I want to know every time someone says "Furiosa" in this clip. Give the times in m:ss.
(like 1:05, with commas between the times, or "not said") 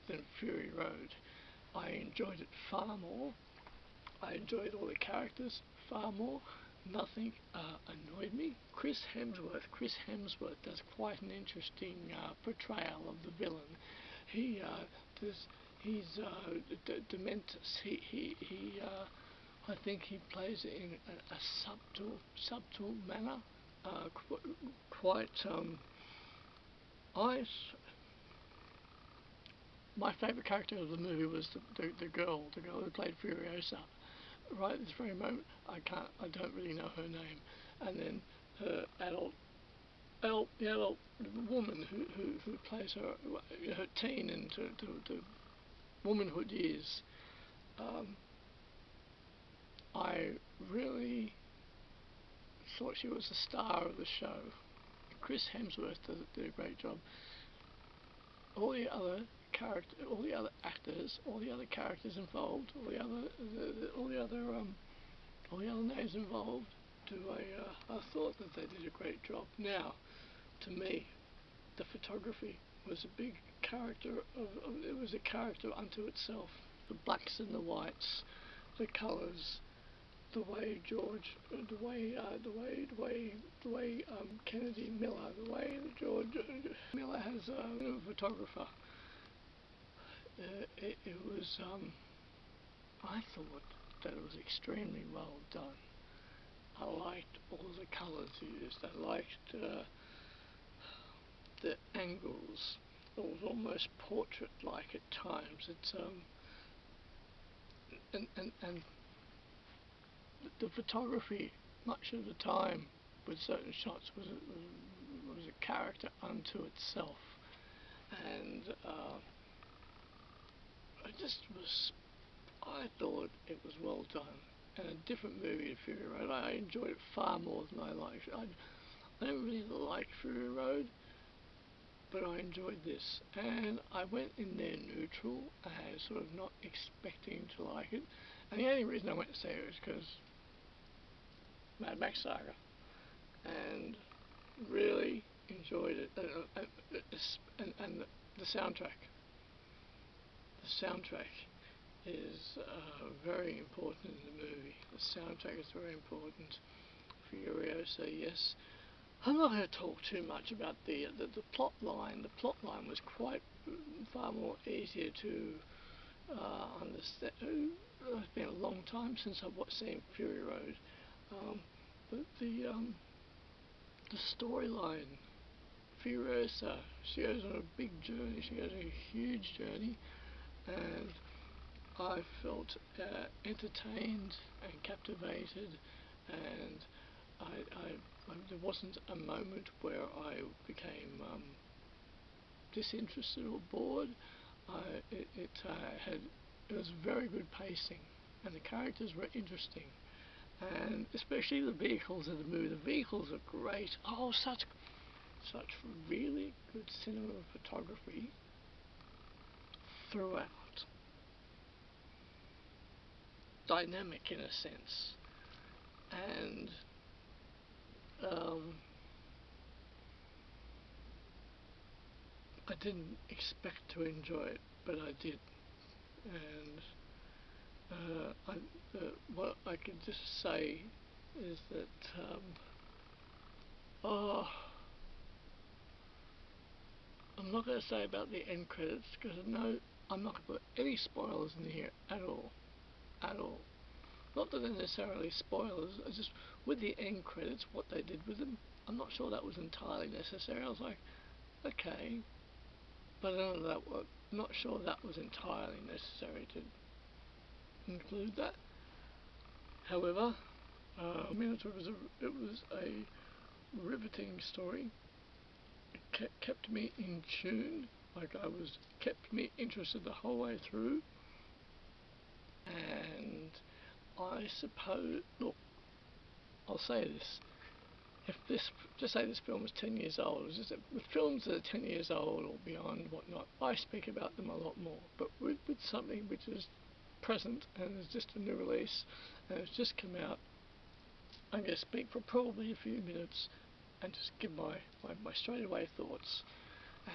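0:33, 2:56.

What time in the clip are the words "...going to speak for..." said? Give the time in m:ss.
4:51.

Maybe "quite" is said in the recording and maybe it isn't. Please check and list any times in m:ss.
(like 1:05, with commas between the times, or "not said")
0:10, 0:24, 2:43.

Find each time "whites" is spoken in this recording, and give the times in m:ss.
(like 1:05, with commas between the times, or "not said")
1:17.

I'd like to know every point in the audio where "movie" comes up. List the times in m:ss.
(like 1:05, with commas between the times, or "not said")
0:30, 2:05, 2:34, 3:22.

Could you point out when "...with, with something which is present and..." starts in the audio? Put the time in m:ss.
4:45.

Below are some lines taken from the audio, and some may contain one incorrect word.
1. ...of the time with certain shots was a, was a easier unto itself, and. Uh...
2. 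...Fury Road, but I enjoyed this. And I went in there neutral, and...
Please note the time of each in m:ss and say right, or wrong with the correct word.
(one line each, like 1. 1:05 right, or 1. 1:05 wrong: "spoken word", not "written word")
1. 1:52 wrong: "character", not "easier"
2. 2:10 right.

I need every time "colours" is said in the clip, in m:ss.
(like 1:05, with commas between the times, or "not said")
1:18, 1:37.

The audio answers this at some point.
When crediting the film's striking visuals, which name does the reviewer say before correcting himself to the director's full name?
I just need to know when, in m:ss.
1:24.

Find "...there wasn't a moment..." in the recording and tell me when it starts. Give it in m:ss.
3:08.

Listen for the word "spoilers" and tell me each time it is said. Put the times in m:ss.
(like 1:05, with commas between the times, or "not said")
4:00, 4:05.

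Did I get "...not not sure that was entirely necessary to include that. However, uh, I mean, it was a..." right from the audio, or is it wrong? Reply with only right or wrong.
right.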